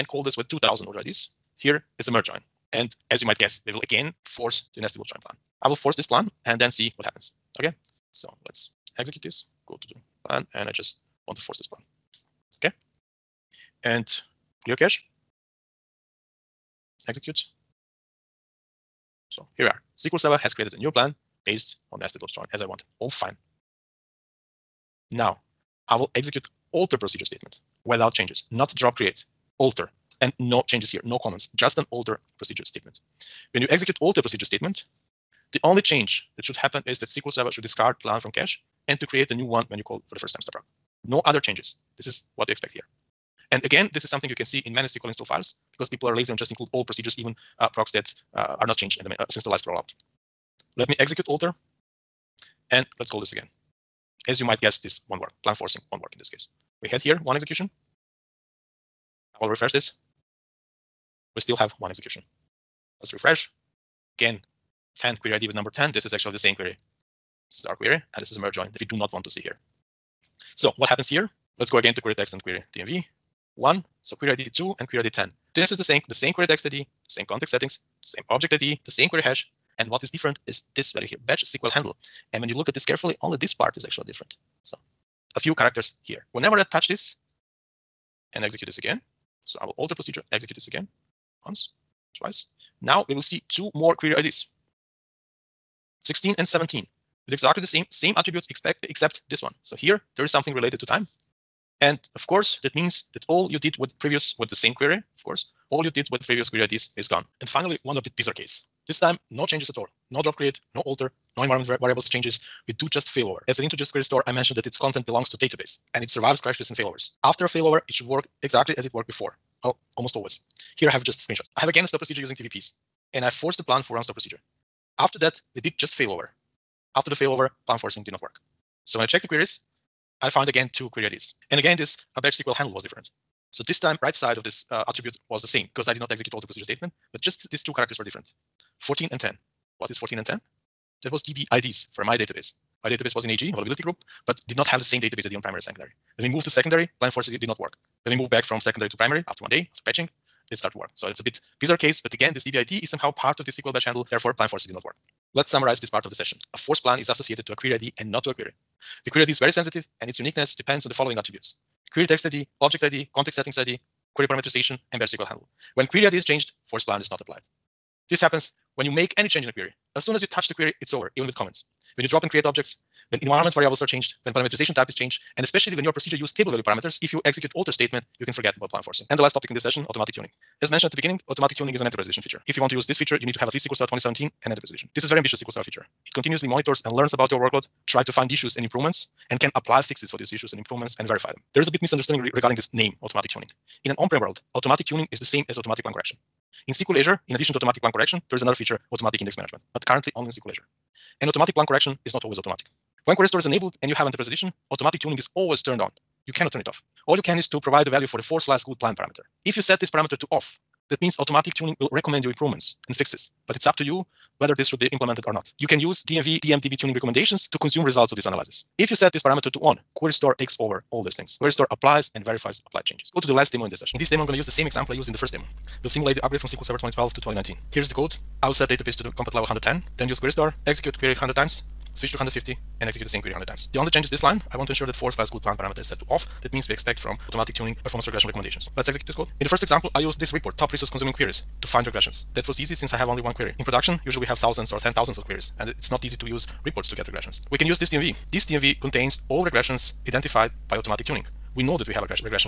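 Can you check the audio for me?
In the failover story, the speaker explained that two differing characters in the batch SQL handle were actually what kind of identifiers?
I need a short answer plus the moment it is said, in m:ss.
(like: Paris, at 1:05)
DB IDs, at 2:21.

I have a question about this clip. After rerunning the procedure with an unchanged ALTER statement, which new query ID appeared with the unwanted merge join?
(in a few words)
10.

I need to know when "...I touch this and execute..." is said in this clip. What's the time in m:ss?
1:26.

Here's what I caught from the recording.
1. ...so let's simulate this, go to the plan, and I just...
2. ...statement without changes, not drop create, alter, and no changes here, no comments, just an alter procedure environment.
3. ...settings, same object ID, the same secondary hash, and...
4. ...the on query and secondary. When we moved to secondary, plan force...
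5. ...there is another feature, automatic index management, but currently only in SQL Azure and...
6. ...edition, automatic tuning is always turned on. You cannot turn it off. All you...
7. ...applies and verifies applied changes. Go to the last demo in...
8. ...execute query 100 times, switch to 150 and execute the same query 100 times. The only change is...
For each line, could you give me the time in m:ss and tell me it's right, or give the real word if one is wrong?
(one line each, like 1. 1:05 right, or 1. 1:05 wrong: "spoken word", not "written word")
1. 0:08 wrong: "execute", not "simulate"
2. 0:27 wrong: "statement", not "environment"
3. 1:17 wrong: "query", not "secondary"
4. 2:25 wrong: "primary", not "query"
5. 3:18 right
6. 3:24 right
7. 3:41 right
8. 3:50 right.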